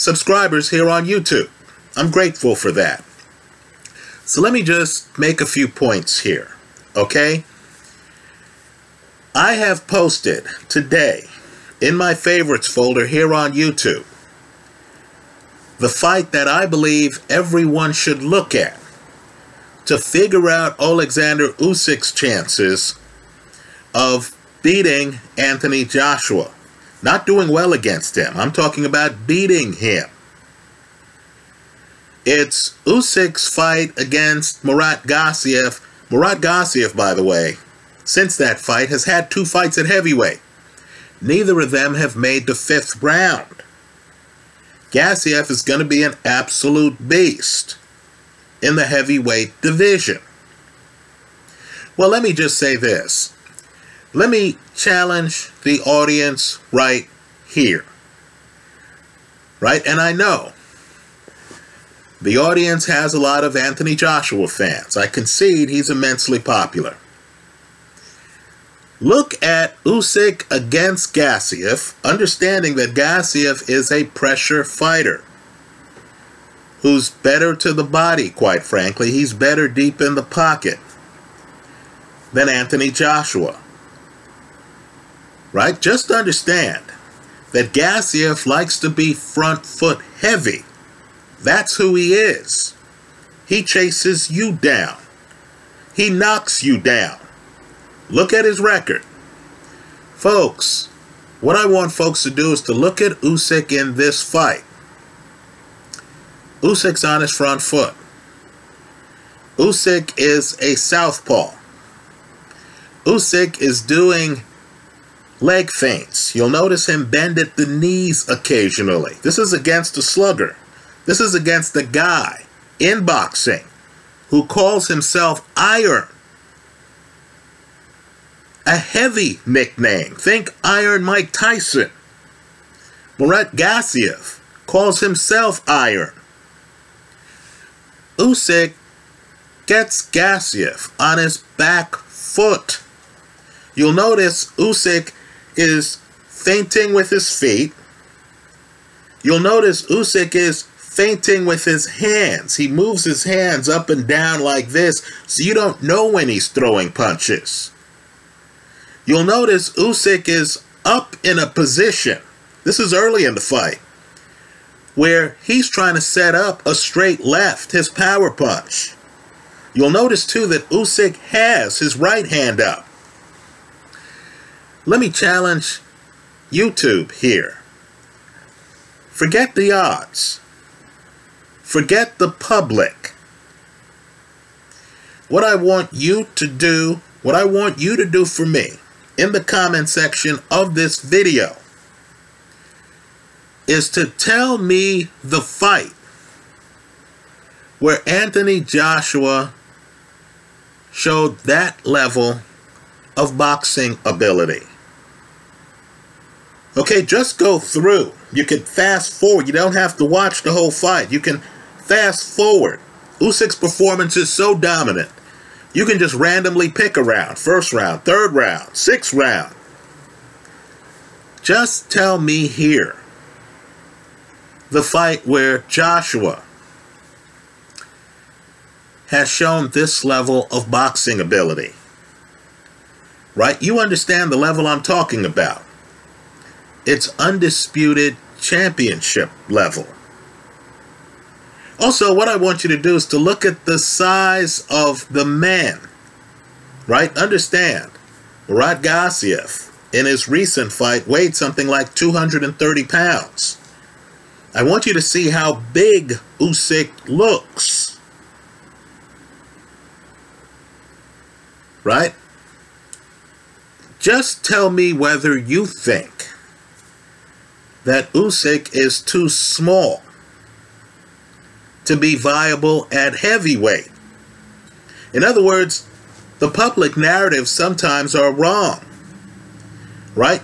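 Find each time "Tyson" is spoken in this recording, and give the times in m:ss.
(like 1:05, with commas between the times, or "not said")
2:11.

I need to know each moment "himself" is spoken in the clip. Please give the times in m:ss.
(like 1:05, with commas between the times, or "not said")
2:04, 2:14.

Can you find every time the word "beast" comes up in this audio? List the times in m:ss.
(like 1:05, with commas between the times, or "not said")
0:47.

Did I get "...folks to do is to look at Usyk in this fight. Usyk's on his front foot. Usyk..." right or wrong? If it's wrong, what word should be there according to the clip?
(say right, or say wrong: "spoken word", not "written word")
right.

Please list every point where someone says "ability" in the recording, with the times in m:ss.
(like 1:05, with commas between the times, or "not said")
3:24, 3:51.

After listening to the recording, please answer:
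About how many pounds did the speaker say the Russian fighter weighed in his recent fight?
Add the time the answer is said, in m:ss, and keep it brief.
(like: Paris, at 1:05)
230 pounds, at 4:11.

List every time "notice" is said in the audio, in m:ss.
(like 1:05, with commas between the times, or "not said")
1:56, 2:23, 2:29, 2:39, 2:49.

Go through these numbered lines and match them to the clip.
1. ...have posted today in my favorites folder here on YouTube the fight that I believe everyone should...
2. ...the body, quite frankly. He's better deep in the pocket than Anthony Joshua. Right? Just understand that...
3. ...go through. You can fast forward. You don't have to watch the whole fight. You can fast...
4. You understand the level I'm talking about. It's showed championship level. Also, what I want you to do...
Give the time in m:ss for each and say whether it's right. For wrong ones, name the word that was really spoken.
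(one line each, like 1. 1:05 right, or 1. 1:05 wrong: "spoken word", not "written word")
1. 0:09 right
2. 1:17 right
3. 3:27 right
4. 3:53 wrong: "undisputed", not "showed".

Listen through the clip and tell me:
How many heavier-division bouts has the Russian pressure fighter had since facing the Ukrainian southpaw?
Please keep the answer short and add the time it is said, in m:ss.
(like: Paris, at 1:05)
2, at 0:39.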